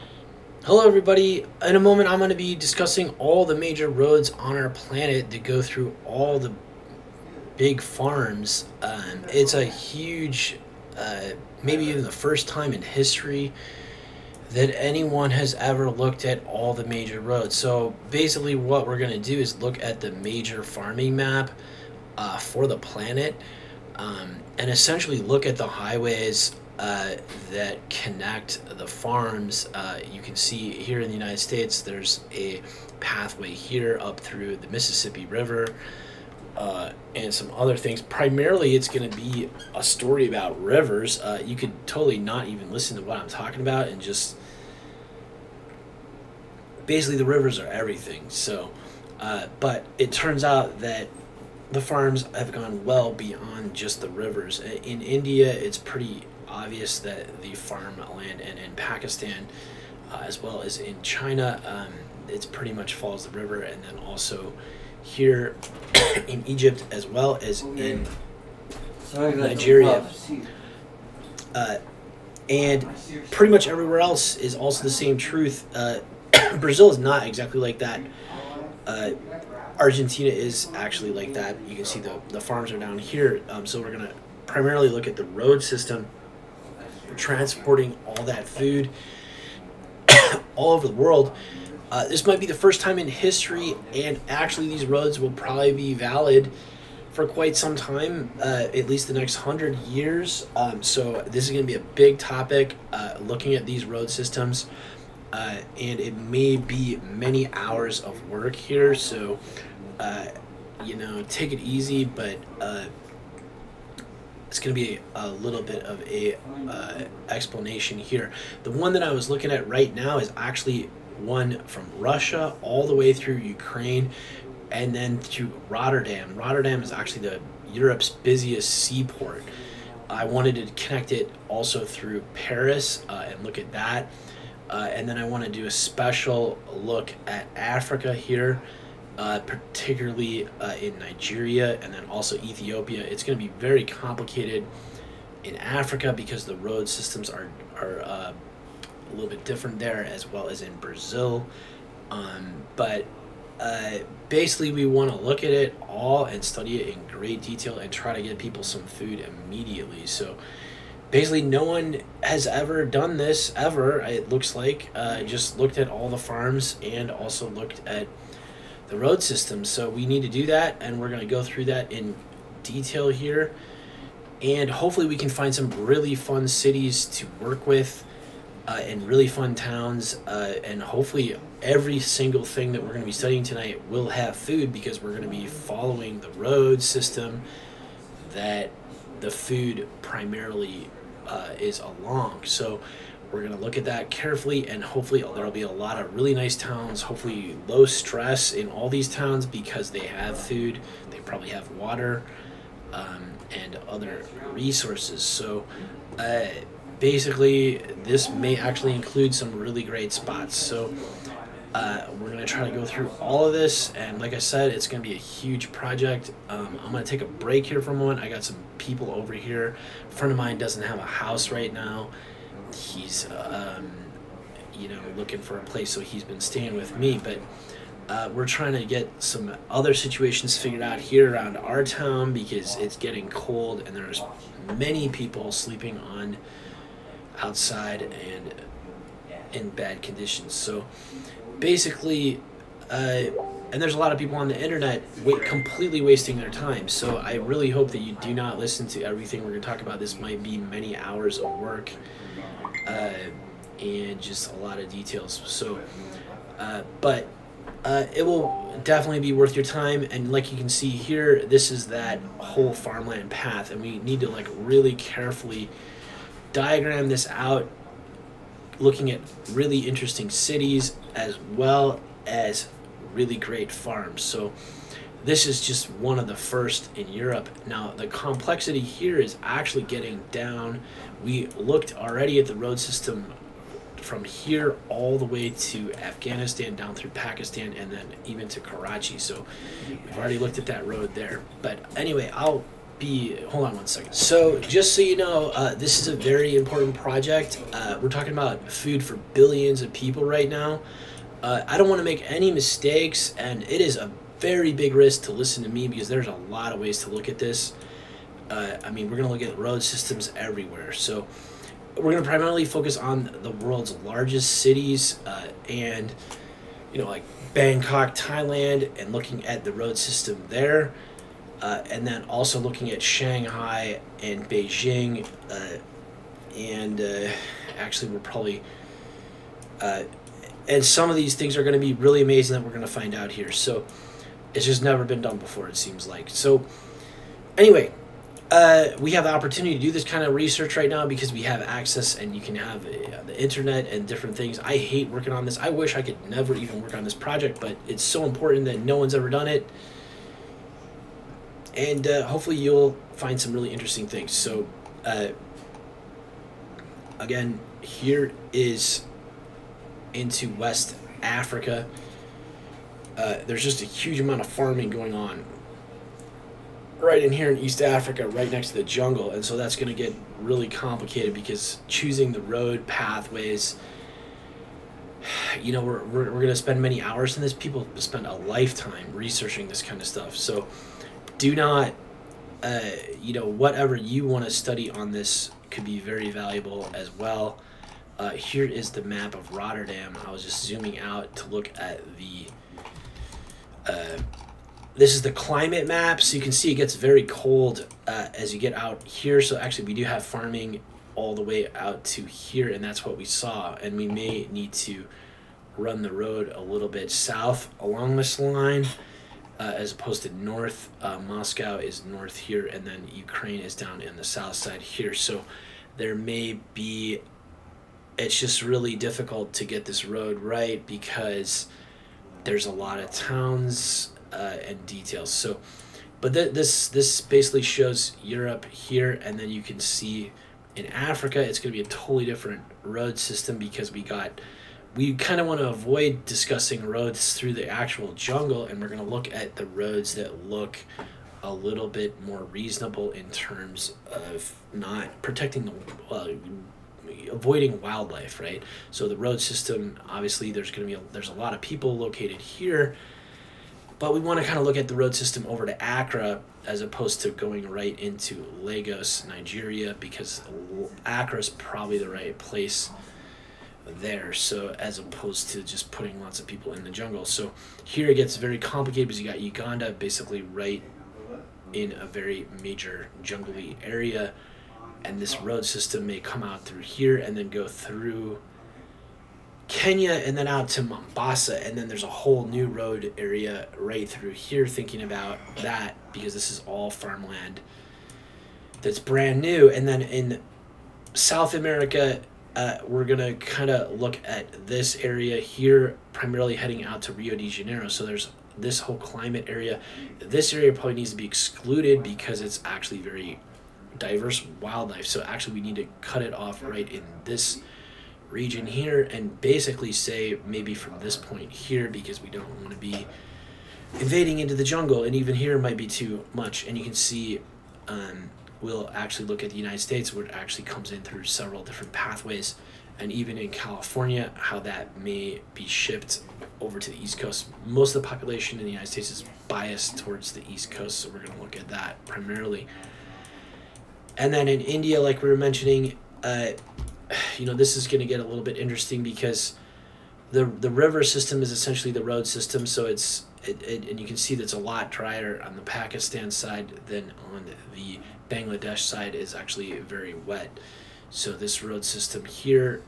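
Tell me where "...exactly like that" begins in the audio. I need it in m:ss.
1:17.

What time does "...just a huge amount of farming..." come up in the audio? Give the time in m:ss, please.
6:03.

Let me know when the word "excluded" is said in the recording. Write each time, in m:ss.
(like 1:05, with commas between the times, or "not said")
8:21.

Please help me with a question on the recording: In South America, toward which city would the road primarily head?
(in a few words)
Rio de Janeiro.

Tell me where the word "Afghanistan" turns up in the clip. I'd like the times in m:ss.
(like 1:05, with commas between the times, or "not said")
4:45.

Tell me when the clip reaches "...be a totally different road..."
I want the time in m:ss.
7:11.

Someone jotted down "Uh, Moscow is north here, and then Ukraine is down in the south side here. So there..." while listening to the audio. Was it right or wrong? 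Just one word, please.
right.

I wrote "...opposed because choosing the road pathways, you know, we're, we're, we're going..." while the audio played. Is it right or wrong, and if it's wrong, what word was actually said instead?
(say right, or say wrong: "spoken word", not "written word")
wrong: "complicated", not "opposed".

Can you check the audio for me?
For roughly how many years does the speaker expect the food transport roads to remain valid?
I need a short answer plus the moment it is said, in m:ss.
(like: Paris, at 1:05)
100, at 1:39.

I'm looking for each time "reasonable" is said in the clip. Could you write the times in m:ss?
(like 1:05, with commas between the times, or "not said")
7:22.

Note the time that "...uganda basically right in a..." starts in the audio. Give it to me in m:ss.
7:49.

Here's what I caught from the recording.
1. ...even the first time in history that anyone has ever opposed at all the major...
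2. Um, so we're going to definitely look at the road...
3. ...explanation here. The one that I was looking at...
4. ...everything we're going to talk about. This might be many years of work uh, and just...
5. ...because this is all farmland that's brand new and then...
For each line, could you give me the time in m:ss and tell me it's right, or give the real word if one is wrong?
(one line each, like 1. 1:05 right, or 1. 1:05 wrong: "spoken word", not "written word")
1. 0:11 wrong: "looked", not "opposed"
2. 1:23 wrong: "primarily", not "definitely"
3. 1:57 right
4. 4:09 wrong: "hours", not "years"
5. 8:06 right.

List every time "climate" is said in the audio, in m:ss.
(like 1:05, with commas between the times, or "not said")
6:35, 8:18.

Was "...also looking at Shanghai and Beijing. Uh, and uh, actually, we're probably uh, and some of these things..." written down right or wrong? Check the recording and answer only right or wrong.
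right.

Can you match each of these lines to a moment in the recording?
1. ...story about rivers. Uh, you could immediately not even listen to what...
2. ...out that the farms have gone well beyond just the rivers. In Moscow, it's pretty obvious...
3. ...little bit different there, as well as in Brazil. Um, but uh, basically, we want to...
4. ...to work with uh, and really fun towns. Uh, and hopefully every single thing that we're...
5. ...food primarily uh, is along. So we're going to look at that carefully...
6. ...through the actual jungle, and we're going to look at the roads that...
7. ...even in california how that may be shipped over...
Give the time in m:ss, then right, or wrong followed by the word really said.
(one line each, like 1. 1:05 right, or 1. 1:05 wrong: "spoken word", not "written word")
1. 0:39 wrong: "totally", not "immediately"
2. 0:50 wrong: "India", not "Moscow"
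3. 2:29 right
4. 2:57 right
5. 3:09 right
6. 7:17 right
7. 8:43 right.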